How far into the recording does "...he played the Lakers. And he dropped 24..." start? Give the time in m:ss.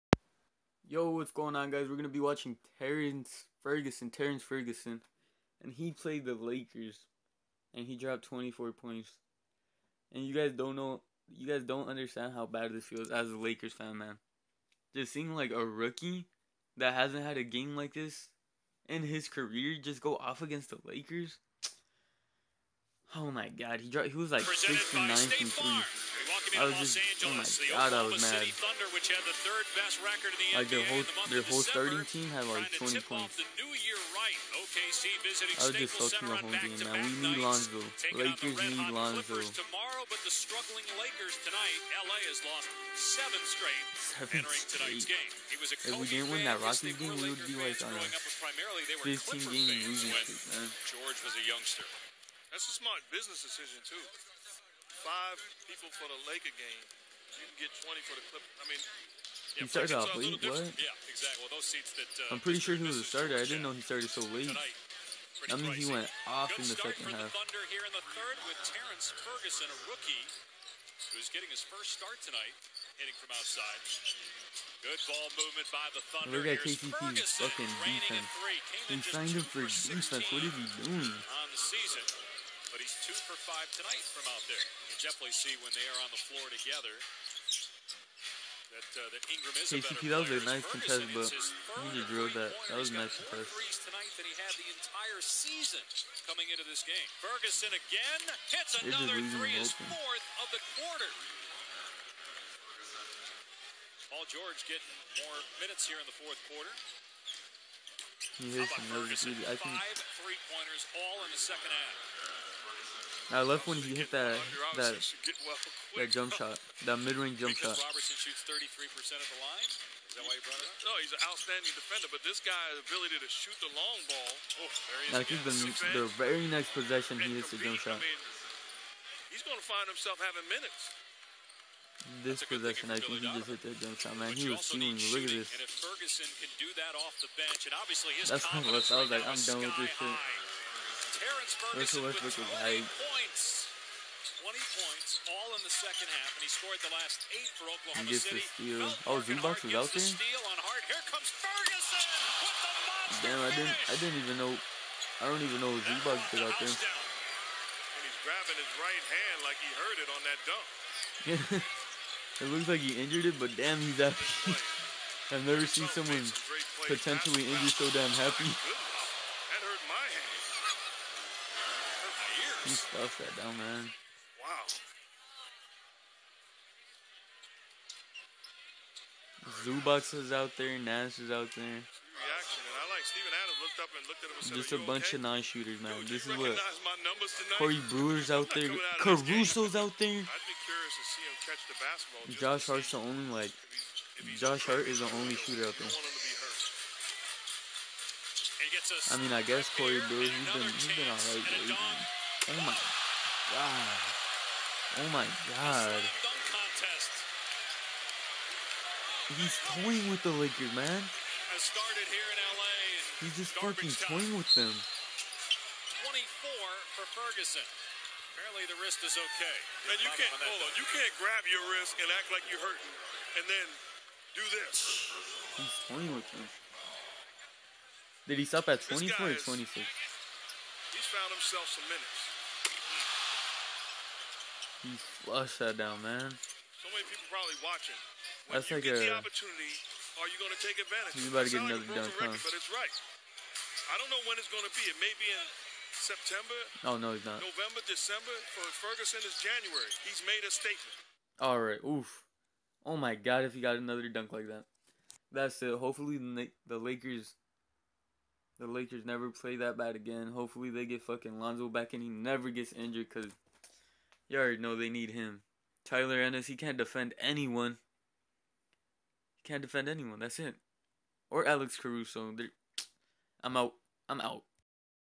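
0:05.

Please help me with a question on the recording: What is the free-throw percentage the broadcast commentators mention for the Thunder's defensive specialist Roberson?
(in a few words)
33%.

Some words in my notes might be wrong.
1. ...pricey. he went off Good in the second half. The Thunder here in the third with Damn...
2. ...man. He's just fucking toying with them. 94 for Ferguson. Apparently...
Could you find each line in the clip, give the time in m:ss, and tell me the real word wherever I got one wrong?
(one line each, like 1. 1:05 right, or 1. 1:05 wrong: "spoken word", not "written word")
1. 1:05 wrong: "Terrance", not "Damn"
2. 3:30 wrong: "24", not "94".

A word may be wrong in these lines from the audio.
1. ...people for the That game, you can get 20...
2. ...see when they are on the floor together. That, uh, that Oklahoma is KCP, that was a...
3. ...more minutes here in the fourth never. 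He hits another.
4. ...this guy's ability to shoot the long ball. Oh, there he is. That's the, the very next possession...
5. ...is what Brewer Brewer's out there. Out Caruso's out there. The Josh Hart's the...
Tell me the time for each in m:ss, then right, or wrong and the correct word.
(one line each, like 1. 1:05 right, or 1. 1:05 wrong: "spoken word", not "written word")
1. 0:55 wrong: "Laker", not "That"
2. 1:25 wrong: "Ingram", not "Oklahoma"
3. 1:45 wrong: "quarter", not "never"
4. 2:02 right
5. 3:06 wrong: "Corey", not "Brewer".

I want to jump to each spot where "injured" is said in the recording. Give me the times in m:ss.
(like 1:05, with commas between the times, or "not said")
2:42, 2:47, 4:22.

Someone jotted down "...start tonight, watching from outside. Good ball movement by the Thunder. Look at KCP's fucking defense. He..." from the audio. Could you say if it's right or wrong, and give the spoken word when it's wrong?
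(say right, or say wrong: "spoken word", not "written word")
wrong: "hitting", not "watching".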